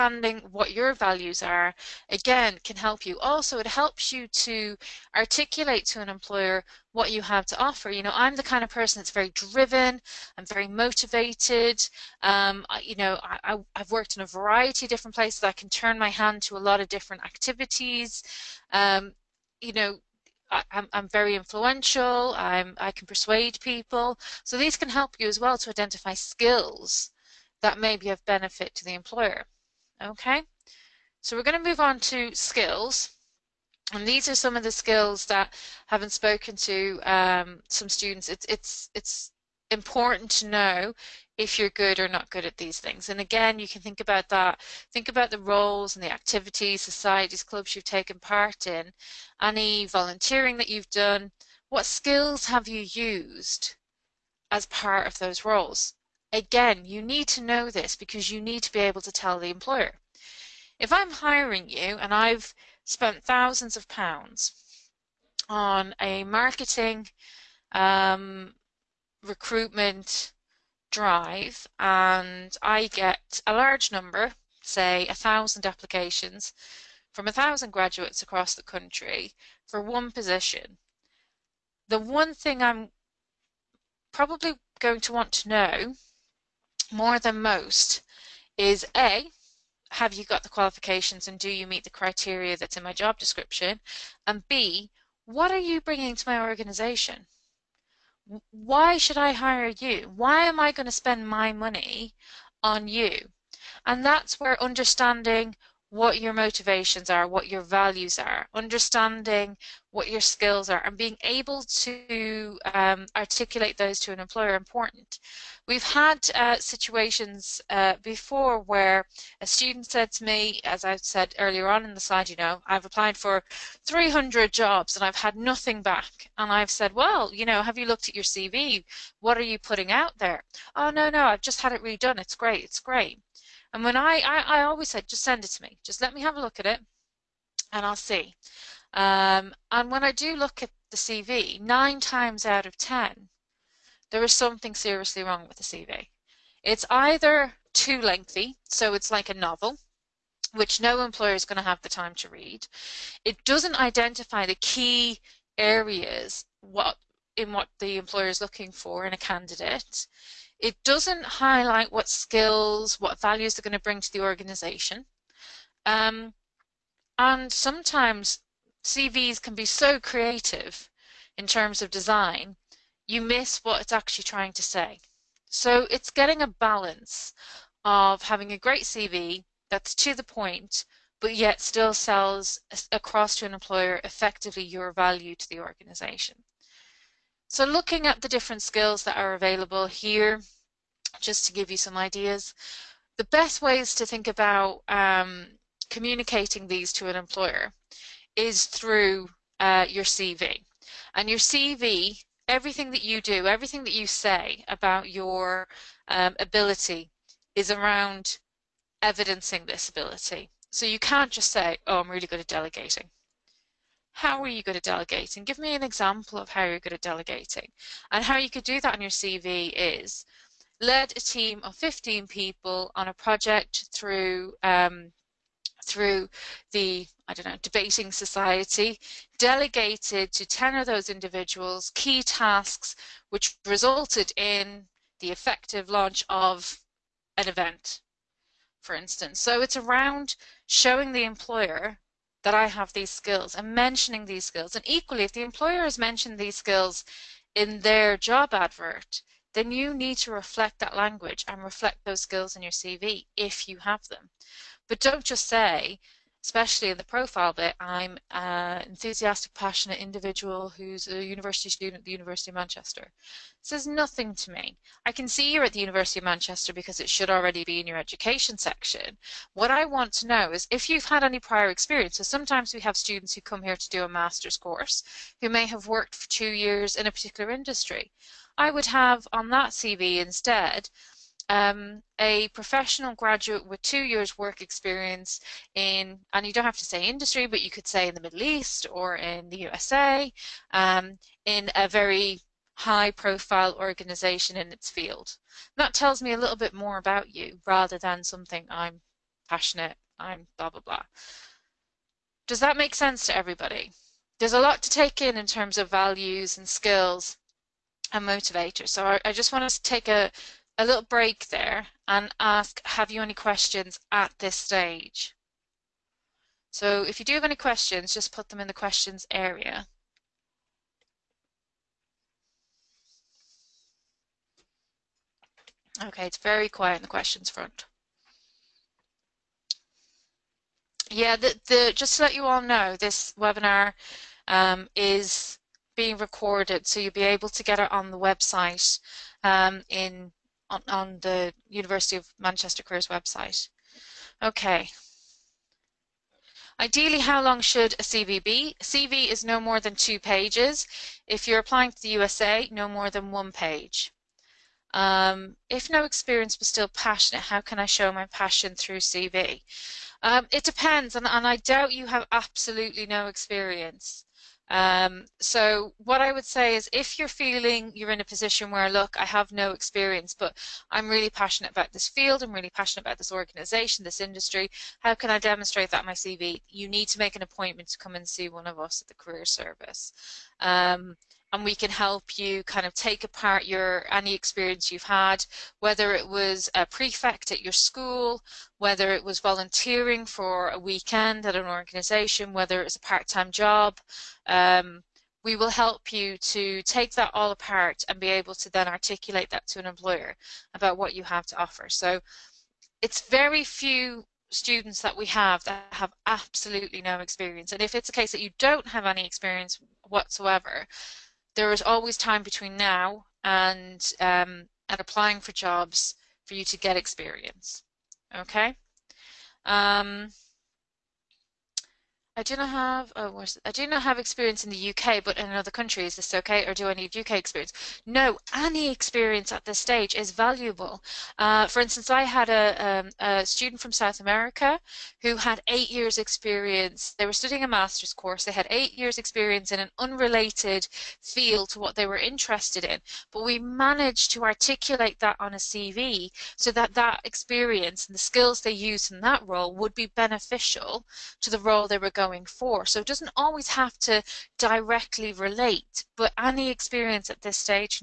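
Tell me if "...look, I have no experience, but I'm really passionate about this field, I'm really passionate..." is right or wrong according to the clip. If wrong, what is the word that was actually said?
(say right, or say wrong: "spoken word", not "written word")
right.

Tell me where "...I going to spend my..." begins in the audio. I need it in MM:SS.
01:40.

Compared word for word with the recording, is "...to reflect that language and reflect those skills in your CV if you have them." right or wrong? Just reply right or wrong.
right.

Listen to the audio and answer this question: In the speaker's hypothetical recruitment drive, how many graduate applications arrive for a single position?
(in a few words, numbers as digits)
1000.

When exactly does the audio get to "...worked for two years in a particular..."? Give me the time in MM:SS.
04:35.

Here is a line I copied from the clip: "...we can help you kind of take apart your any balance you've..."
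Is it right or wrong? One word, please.
wrong.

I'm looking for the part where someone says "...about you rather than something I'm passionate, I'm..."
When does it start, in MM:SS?
04:56.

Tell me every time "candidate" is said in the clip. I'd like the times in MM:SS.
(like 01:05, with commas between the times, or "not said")
02:39.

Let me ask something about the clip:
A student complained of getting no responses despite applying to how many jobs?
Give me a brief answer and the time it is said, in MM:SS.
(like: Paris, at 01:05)
300, at 02:03.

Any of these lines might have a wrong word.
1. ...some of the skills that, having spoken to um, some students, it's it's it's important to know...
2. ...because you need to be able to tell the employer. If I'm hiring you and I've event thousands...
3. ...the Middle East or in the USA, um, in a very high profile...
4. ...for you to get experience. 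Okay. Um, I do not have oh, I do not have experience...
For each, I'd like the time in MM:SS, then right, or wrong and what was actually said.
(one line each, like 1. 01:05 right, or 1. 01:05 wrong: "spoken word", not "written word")
1. 00:34 right
2. 00:57 wrong: "spent", not "event"
3. 04:48 right
4. 06:56 right.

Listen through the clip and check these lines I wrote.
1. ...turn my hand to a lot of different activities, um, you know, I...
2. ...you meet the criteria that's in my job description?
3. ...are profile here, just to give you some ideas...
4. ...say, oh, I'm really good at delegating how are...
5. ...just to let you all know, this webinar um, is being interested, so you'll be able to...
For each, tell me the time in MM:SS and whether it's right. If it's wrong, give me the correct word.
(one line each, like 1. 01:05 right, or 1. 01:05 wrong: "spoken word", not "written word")
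1. 00:15 right
2. 01:31 right
3. 03:09 wrong: "available", not "profile"
4. 03:31 right
5. 05:31 wrong: "recorded", not "interested".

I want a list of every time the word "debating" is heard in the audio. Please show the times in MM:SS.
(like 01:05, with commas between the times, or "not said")
03:47.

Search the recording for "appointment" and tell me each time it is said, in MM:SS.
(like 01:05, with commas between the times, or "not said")
06:17.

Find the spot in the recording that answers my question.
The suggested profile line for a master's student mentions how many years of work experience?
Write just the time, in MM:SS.
04:43.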